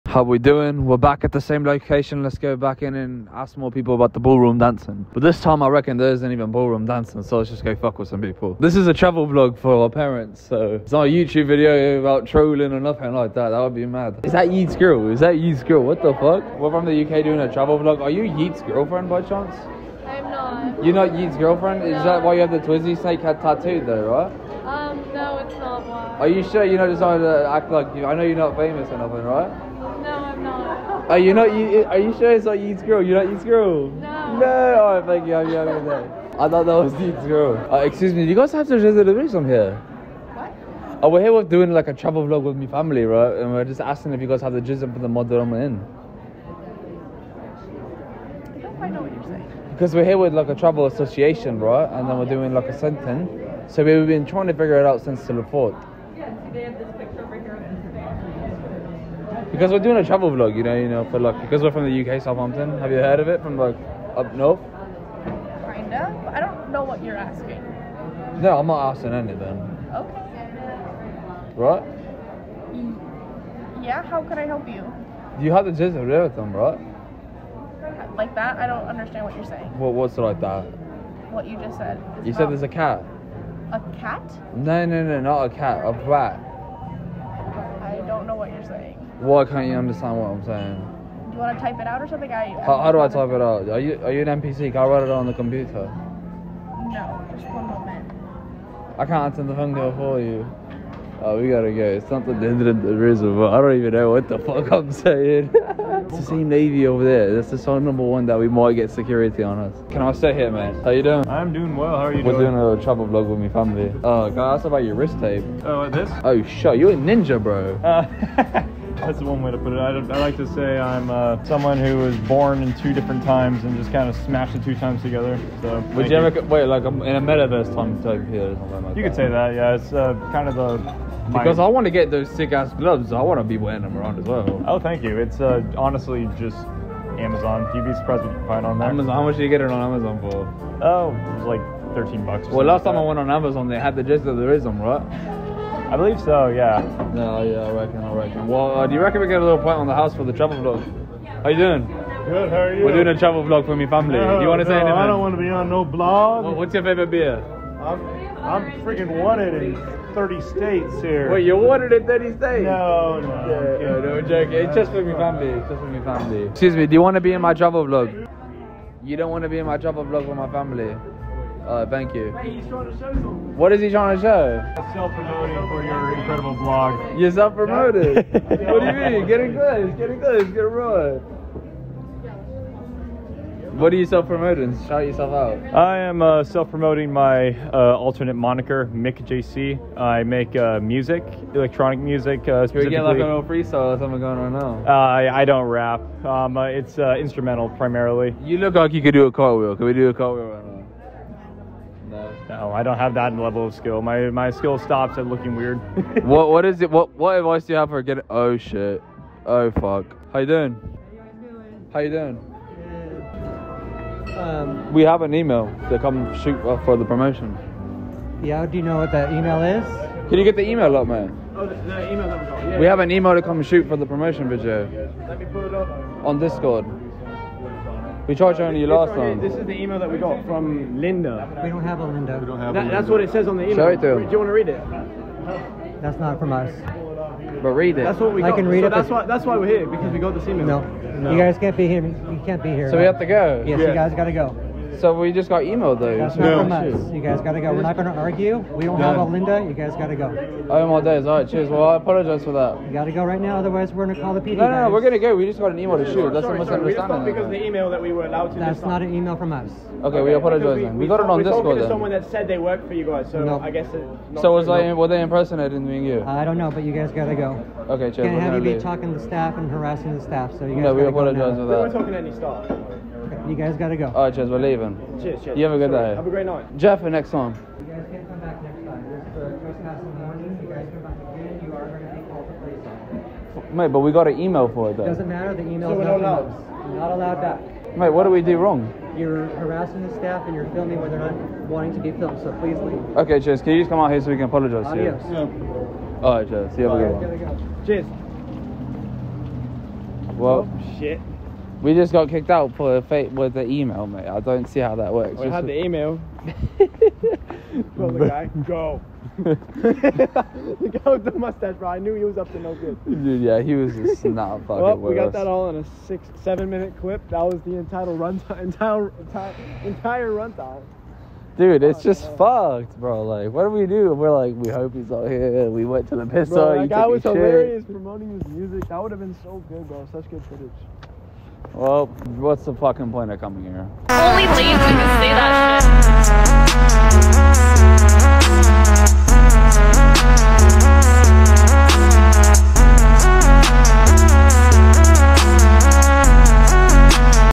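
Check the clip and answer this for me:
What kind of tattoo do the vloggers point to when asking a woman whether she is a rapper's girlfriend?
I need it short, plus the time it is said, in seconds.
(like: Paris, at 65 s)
Twizzy snake head, at 22 s.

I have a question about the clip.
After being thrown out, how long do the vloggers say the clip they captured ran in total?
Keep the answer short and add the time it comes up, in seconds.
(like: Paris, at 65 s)
6 or 7 minutes, at 316 s.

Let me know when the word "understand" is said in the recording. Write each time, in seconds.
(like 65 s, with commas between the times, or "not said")
78 s, 89 s.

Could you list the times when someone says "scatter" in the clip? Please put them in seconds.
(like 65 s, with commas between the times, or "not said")
not said.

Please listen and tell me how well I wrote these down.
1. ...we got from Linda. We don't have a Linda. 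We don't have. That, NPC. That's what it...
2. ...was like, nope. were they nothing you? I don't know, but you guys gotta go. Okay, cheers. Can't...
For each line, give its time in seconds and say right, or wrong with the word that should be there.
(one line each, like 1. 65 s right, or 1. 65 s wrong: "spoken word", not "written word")
1. 230 s wrong: "Linda", not "NPC"
2. 264 s wrong: "impersonating", not "nothing".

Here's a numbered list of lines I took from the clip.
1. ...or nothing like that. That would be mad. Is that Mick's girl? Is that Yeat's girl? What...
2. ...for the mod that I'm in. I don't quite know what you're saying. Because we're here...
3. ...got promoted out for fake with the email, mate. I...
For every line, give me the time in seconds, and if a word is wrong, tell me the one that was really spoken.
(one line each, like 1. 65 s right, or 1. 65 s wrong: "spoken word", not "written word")
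1. 12 s wrong: "Yeat", not "Mick"
2. 44 s right
3. 302 s wrong: "kicked", not "promoted".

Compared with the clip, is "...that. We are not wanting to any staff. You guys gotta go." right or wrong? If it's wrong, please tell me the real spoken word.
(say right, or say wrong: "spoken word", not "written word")
wrong: "talking", not "wanting".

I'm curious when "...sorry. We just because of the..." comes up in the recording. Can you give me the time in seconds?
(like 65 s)
256 s.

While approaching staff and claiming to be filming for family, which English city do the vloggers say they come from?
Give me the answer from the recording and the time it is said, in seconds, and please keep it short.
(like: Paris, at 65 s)
Southampton, at 62 s.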